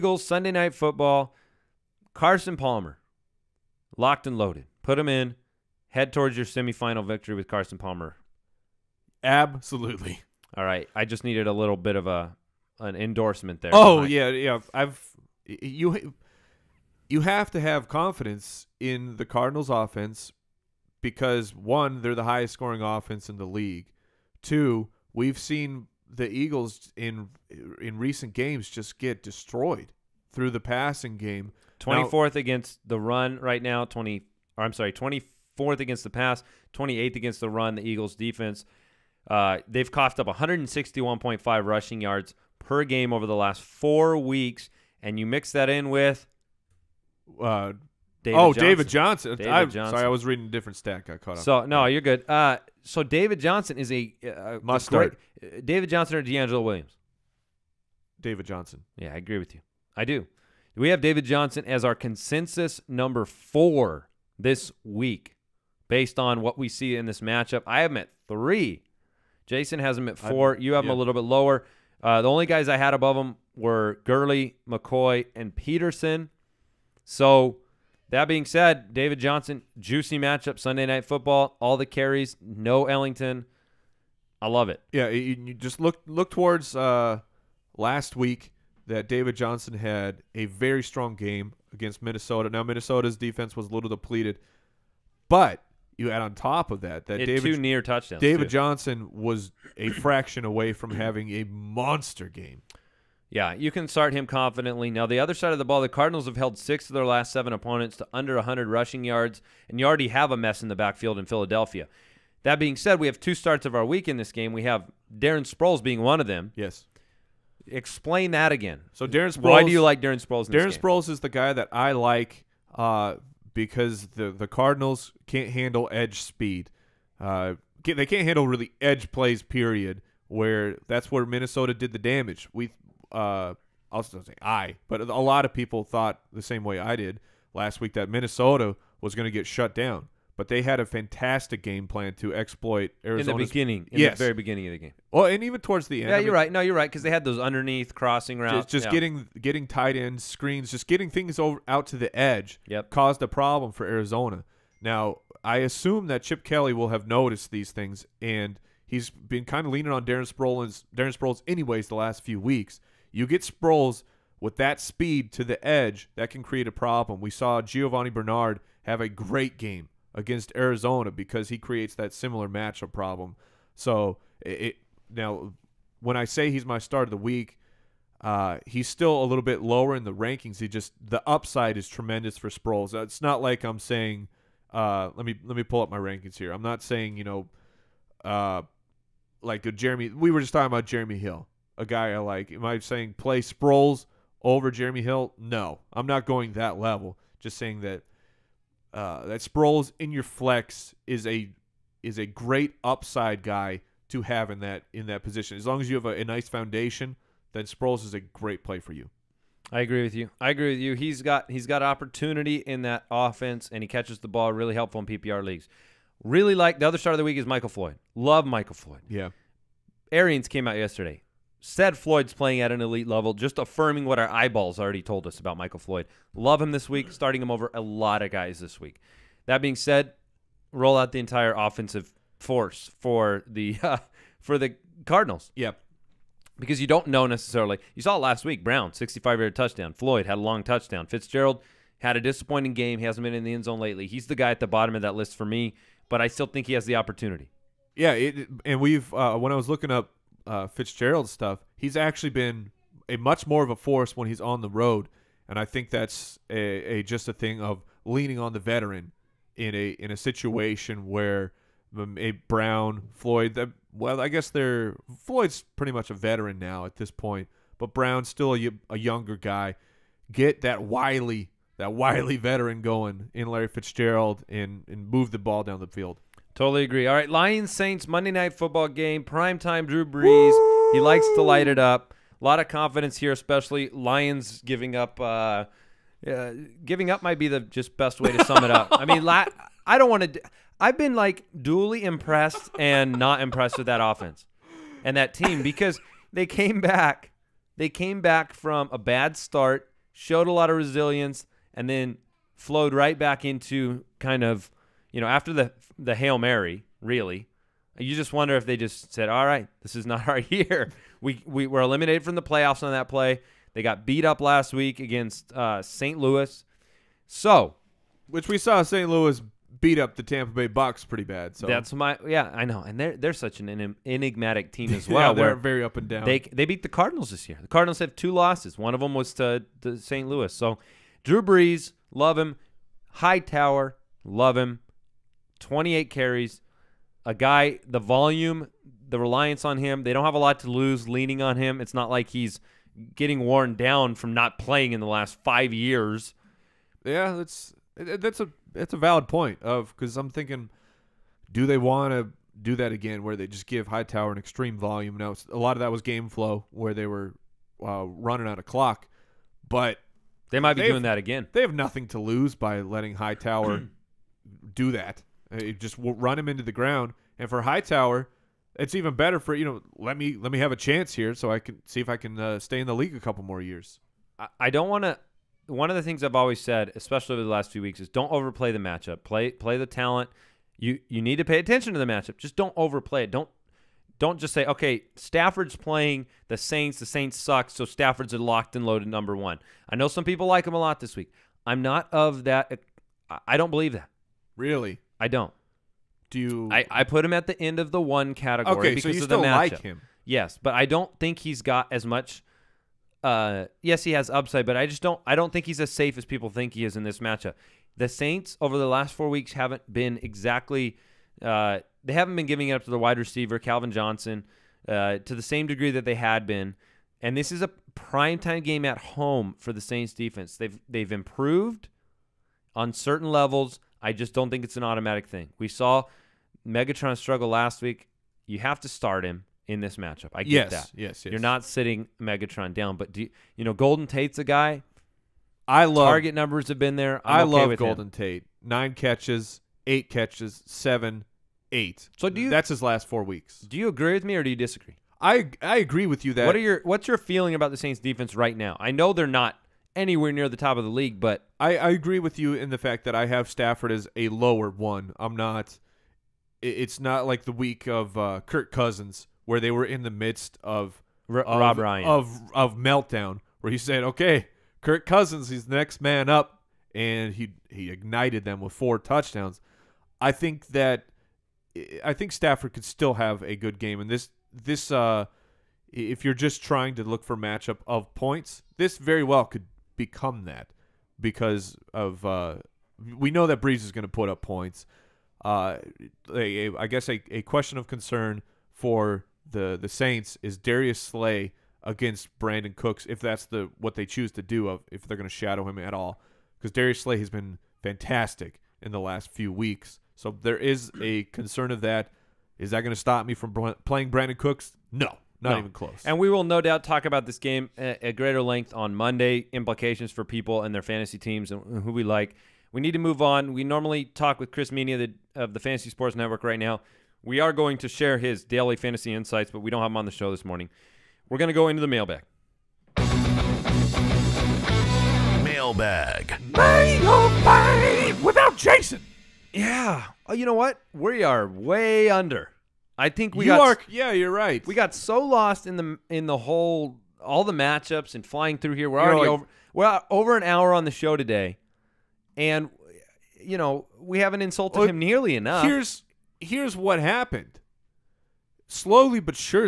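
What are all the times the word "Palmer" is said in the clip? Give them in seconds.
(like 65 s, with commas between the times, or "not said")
2 s, 7 s.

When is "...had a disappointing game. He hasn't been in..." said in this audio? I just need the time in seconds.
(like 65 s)
241 s.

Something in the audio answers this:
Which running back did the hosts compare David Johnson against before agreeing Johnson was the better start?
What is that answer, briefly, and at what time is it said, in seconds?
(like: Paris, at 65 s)
DeAngelo Williams, at 56 s.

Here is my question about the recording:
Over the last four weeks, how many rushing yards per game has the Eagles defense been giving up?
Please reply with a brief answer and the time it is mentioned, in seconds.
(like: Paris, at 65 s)
161.5, at 40 s.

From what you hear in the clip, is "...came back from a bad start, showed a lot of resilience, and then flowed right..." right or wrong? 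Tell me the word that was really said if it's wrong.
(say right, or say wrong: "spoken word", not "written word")
right.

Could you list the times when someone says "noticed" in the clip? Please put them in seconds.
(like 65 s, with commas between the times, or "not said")
157 s.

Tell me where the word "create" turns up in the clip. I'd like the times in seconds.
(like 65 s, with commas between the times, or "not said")
166 s, 171 s.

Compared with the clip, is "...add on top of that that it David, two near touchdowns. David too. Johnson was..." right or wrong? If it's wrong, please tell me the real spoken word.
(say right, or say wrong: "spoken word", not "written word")
right.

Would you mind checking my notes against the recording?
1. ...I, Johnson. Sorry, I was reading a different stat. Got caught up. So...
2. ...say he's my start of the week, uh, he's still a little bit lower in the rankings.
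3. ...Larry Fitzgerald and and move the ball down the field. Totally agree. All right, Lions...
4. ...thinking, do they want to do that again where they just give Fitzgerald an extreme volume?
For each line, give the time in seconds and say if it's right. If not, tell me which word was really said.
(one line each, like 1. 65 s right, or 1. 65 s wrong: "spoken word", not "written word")
1. 49 s right
2. 176 s right
3. 273 s right
4. 350 s wrong: "Hightower", not "Fitzgerald".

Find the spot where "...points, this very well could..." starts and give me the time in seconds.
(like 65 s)
478 s.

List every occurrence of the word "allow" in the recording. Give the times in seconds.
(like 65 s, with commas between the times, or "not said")
not said.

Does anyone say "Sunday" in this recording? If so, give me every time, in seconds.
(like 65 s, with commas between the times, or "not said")
0 s, 80 s.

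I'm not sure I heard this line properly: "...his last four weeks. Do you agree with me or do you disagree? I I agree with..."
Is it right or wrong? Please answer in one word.
right.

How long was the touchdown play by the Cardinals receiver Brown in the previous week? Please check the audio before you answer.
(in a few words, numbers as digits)
65 yards.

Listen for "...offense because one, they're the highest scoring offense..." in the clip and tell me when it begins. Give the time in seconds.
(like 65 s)
19 s.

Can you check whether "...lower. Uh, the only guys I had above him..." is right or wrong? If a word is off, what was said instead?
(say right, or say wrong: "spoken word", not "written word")
right.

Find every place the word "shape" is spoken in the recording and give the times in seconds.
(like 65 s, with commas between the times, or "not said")
not said.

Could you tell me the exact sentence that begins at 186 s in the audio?
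I'm not saying you know uh, like Jeremy.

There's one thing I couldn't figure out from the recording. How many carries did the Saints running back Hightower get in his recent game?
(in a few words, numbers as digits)
28.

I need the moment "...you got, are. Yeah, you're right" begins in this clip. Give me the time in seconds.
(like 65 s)
533 s.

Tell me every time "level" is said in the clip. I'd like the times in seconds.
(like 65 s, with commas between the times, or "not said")
196 s, 223 s, 423 s.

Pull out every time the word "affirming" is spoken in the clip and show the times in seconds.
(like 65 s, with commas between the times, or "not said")
223 s.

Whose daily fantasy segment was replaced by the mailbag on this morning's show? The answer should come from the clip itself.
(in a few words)
Chris Meaney.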